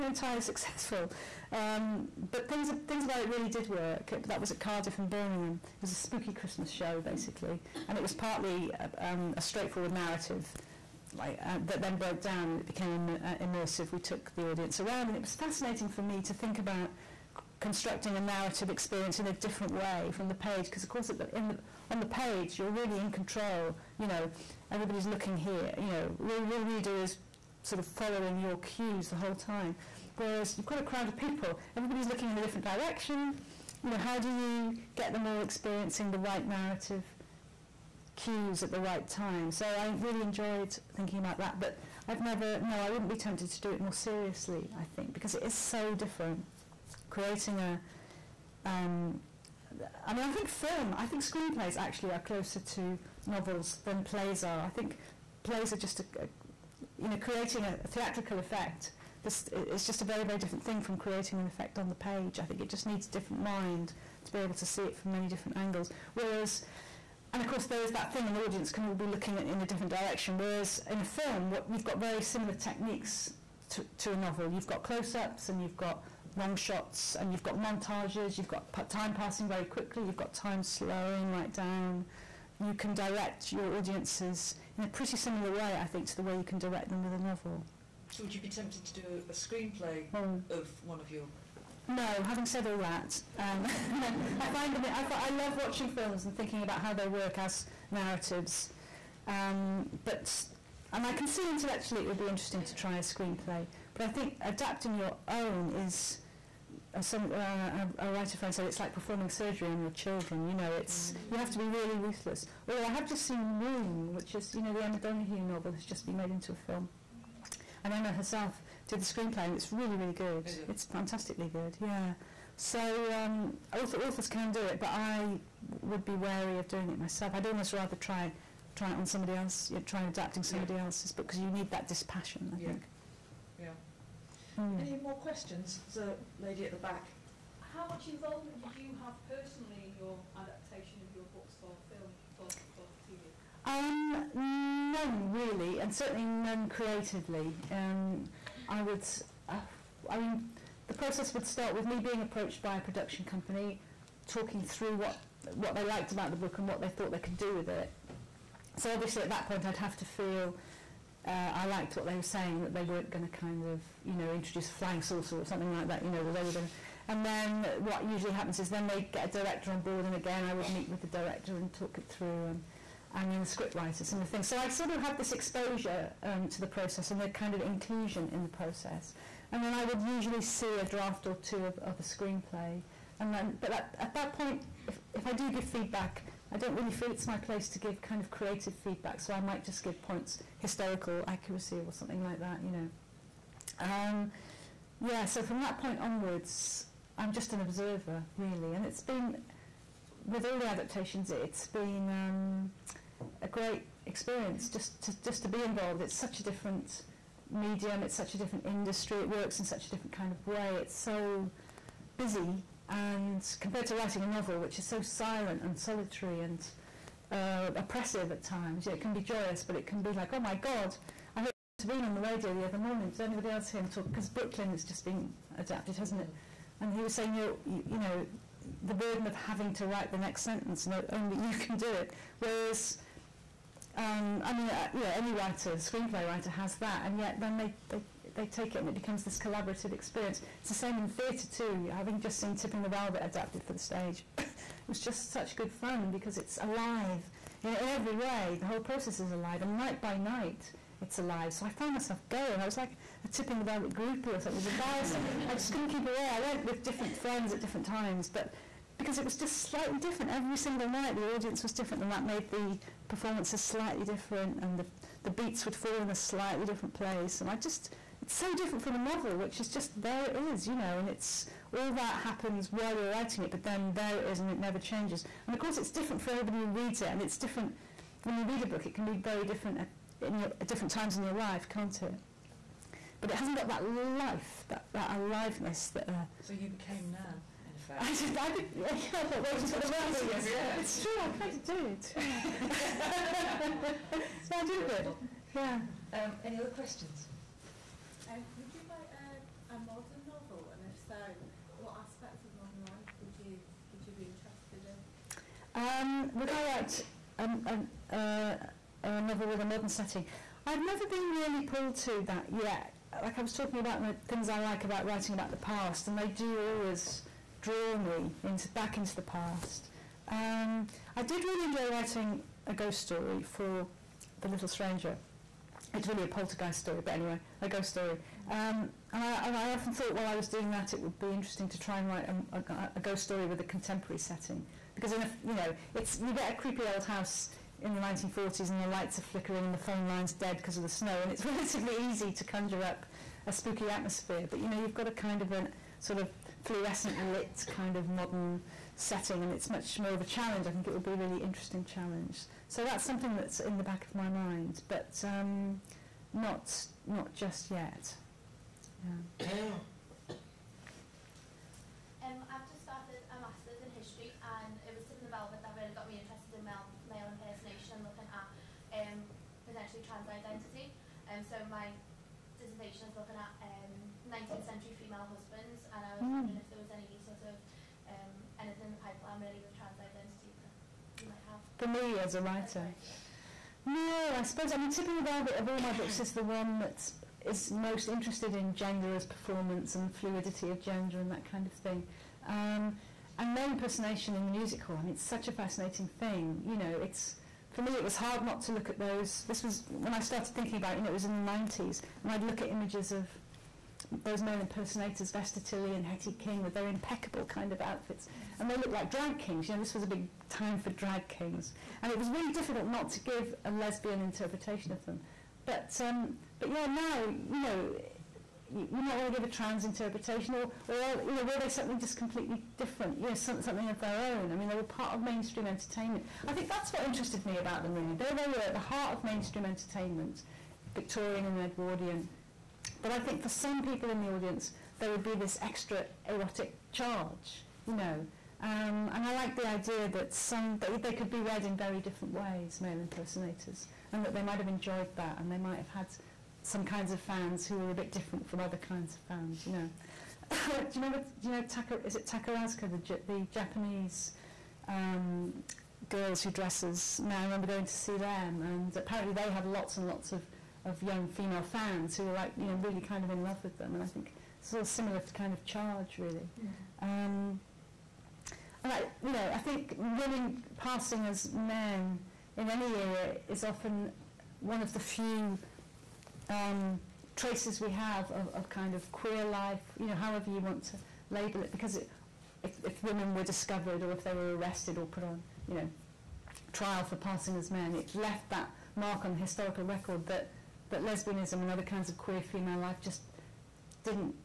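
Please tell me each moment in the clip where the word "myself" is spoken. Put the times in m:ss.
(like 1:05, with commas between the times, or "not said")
2:06, 4:11.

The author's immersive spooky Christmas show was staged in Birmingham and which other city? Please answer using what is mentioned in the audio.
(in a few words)
Cardiff.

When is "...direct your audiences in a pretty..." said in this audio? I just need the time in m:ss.
1:22.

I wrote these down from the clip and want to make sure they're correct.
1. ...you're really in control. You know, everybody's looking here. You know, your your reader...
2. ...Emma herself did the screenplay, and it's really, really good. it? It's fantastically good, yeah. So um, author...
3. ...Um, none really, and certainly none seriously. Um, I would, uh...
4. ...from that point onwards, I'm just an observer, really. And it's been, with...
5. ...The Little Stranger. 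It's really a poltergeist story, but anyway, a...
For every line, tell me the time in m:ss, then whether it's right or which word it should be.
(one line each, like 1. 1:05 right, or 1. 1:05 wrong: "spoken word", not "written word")
1. 0:22 right
2. 1:57 right
3. 2:23 wrong: "creatively", not "seriously"
4. 3:15 right
5. 5:24 right.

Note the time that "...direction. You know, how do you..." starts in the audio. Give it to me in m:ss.
0:32.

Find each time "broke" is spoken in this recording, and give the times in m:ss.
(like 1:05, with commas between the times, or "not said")
0:11.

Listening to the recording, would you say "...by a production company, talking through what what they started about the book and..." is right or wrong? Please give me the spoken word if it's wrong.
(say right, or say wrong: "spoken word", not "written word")
wrong: "liked", not "started".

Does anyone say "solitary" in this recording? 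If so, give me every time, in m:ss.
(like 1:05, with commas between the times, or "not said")
3:35.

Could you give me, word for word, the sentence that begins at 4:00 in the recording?
It's the same in theatre too, having just seen Tipping the Velvet adapted for the stage.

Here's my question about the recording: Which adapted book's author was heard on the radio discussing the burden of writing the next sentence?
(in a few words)
Brooklyn.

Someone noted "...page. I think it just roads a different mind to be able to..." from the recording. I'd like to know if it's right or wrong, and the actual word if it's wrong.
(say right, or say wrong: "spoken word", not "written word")
wrong: "needs", not "roads".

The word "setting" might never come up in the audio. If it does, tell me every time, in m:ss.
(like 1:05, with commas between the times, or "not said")
5:09, 5:34, 5:48.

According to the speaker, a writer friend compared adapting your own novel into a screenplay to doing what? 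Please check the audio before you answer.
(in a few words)
performing surgery on your children.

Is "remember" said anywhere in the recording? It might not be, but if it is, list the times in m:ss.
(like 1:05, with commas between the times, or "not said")
7:30, 7:37.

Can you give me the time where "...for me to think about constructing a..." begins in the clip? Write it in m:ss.
0:15.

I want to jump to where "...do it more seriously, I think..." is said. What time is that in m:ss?
0:43.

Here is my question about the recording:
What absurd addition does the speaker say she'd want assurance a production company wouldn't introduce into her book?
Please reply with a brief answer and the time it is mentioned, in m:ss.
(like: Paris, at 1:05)
a flying saucer, at 2:44.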